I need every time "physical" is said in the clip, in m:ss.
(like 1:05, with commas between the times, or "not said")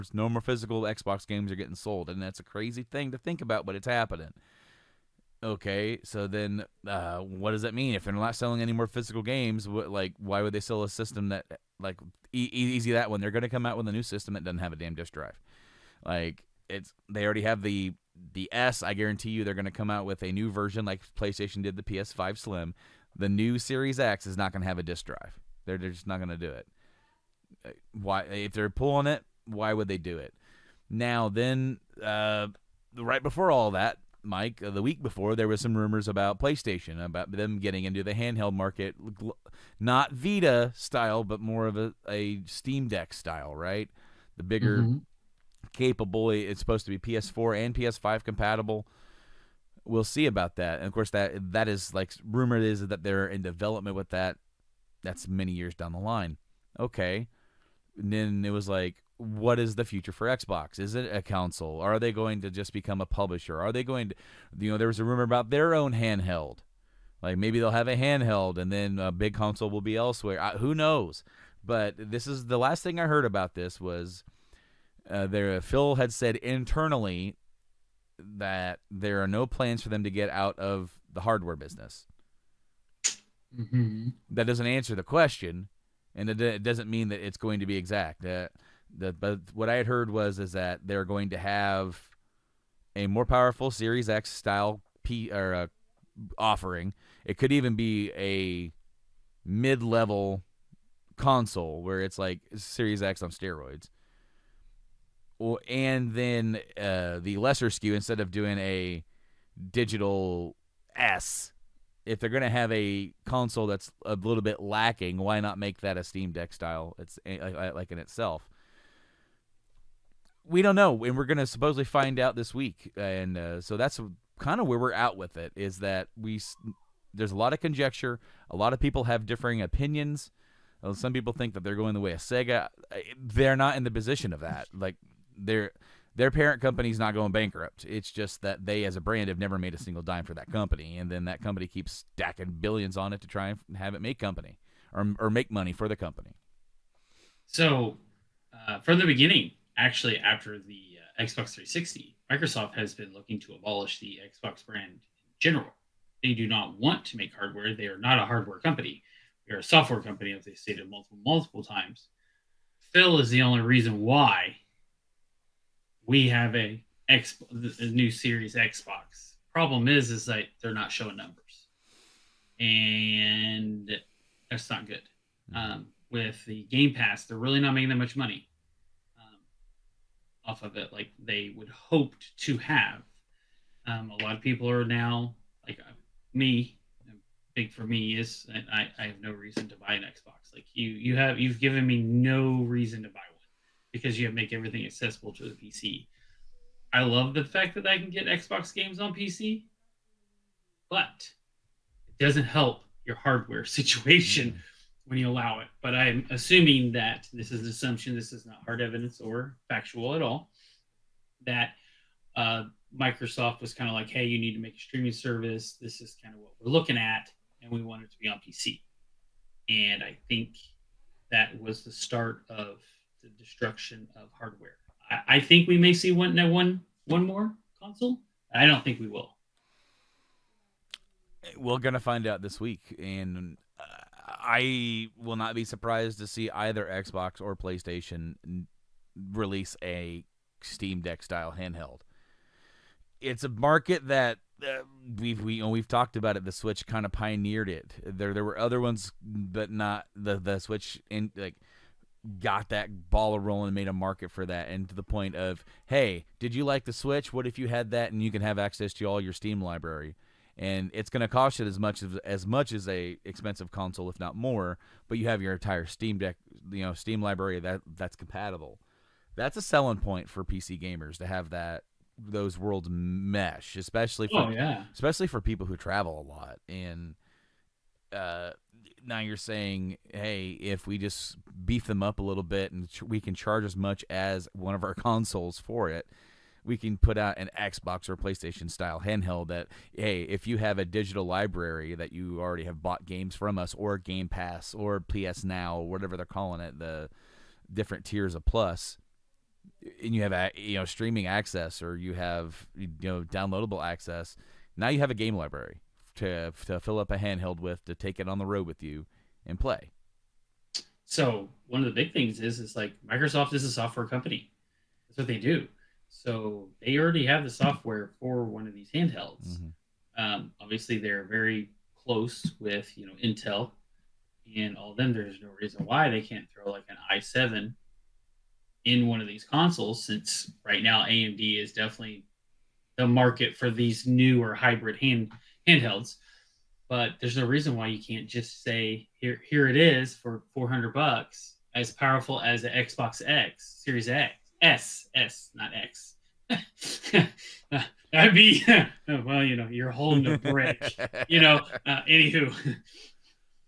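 0:00, 0:08.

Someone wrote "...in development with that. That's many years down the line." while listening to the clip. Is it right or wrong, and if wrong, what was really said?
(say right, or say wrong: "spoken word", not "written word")
right.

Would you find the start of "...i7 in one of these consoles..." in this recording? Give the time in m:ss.
5:27.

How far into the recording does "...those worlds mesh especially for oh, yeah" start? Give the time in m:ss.
4:32.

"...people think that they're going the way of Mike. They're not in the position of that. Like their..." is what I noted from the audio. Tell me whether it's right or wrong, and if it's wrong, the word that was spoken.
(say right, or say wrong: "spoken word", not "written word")
wrong: "Sega", not "Mike".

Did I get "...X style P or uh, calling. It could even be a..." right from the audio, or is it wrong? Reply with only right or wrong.
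wrong.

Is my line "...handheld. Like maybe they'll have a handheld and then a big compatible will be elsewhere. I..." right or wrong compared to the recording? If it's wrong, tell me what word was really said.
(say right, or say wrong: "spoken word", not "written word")
wrong: "console", not "compatible".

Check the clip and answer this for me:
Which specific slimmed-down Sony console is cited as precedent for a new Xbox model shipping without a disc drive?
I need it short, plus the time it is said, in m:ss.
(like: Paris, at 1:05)
PS5 Slim, at 0:21.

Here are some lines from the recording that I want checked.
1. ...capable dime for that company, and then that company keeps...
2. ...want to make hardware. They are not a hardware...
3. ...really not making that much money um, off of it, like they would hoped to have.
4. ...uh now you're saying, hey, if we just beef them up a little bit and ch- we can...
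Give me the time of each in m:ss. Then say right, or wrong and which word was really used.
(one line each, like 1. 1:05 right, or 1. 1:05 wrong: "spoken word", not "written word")
1. 2:19 wrong: "single", not "capable"
2. 2:36 right
3. 2:57 right
4. 4:38 right.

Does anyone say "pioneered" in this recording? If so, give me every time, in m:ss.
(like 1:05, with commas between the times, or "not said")
4:07.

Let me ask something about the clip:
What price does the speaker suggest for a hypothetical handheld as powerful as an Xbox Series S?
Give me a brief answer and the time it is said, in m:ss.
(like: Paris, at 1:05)
$400, at 5:40.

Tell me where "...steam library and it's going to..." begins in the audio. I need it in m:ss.
4:19.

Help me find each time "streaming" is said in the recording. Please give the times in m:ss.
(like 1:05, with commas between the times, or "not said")
3:34, 5:00.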